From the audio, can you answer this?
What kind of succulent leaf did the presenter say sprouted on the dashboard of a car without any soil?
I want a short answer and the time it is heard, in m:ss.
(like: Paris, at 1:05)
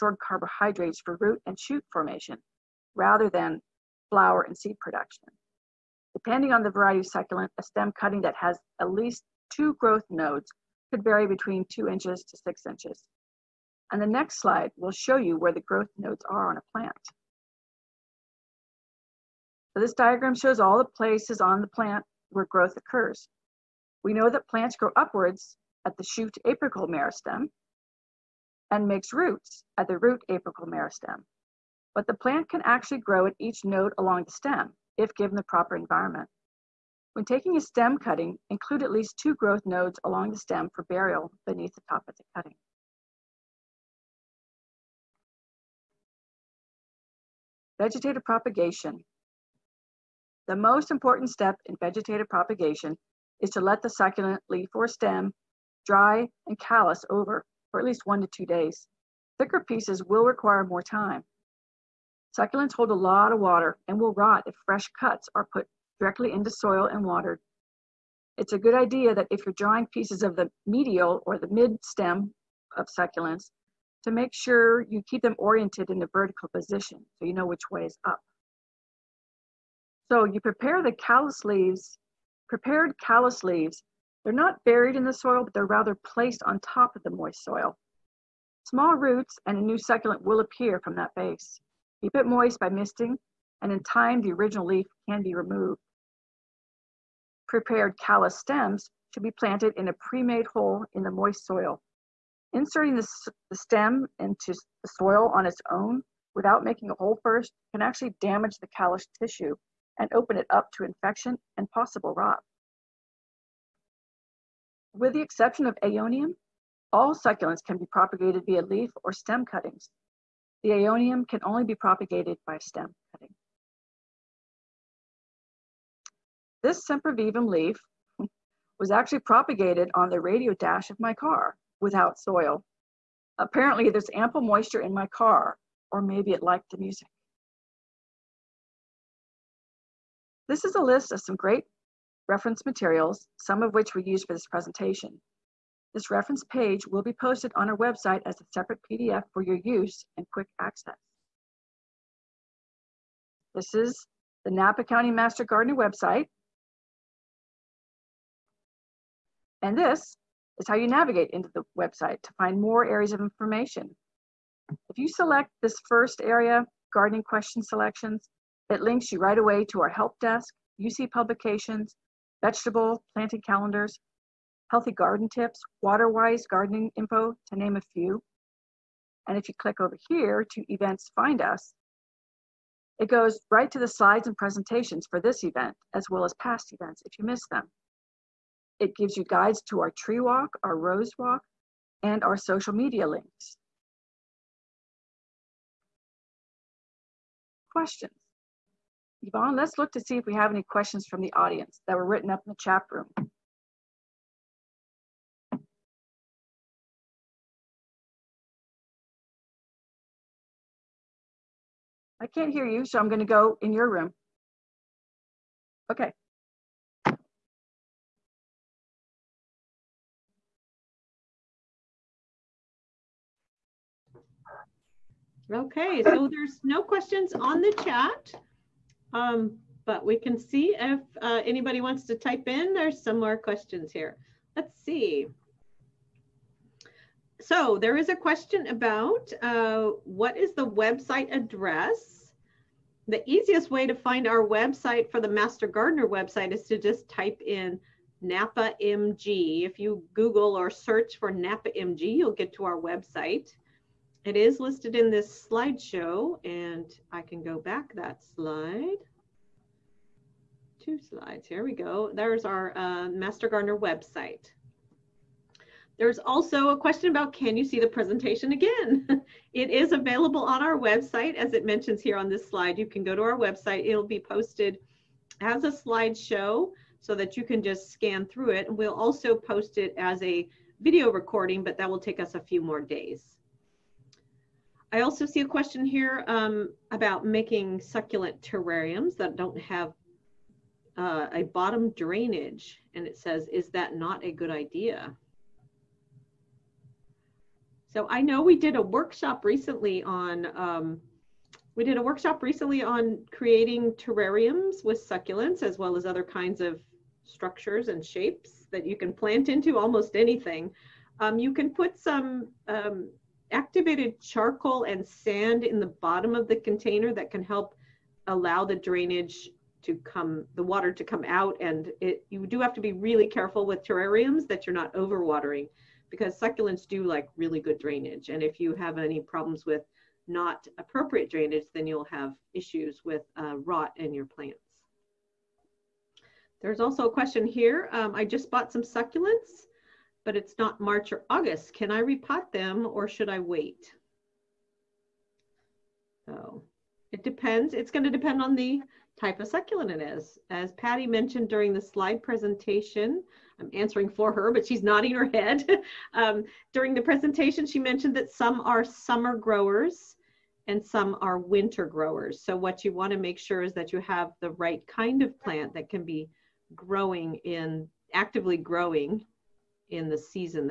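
Sempervivum, at 2:06.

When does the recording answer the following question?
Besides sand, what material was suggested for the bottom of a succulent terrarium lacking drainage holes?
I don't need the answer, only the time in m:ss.
5:13.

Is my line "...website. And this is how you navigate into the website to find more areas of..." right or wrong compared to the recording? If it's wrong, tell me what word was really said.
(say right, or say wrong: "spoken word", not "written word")
right.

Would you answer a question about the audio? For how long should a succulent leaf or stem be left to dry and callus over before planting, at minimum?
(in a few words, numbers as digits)
1 to 2 days.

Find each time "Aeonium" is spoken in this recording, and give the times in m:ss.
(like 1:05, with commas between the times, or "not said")
1:55, 2:00.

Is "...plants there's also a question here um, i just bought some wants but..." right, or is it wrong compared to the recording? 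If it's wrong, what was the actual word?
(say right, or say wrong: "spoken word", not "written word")
wrong: "succulents", not "wants".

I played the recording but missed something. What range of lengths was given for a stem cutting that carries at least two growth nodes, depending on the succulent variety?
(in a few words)
2 to 6 inches.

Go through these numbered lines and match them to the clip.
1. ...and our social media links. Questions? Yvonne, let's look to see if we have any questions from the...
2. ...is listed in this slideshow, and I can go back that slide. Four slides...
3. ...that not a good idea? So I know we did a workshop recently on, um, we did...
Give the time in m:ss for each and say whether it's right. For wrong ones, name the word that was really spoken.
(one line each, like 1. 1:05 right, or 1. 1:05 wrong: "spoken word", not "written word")
1. 3:12 right
2. 4:14 wrong: "Two", not "Four"
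3. 4:53 right.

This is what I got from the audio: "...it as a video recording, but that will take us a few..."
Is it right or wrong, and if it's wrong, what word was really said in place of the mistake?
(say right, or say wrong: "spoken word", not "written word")
right.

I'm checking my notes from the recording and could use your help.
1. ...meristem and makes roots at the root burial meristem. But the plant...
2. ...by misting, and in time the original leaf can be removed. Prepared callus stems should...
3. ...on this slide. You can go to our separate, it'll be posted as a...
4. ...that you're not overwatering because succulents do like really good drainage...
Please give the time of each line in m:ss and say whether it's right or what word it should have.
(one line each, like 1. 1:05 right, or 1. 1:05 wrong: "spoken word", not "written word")
1. 0:26 wrong: "apical", not "burial"
2. 1:32 right
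3. 4:32 wrong: "website", not "separate"
4. 5:24 right.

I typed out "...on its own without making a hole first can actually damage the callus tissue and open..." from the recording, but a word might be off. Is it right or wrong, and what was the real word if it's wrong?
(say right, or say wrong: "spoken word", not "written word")
right.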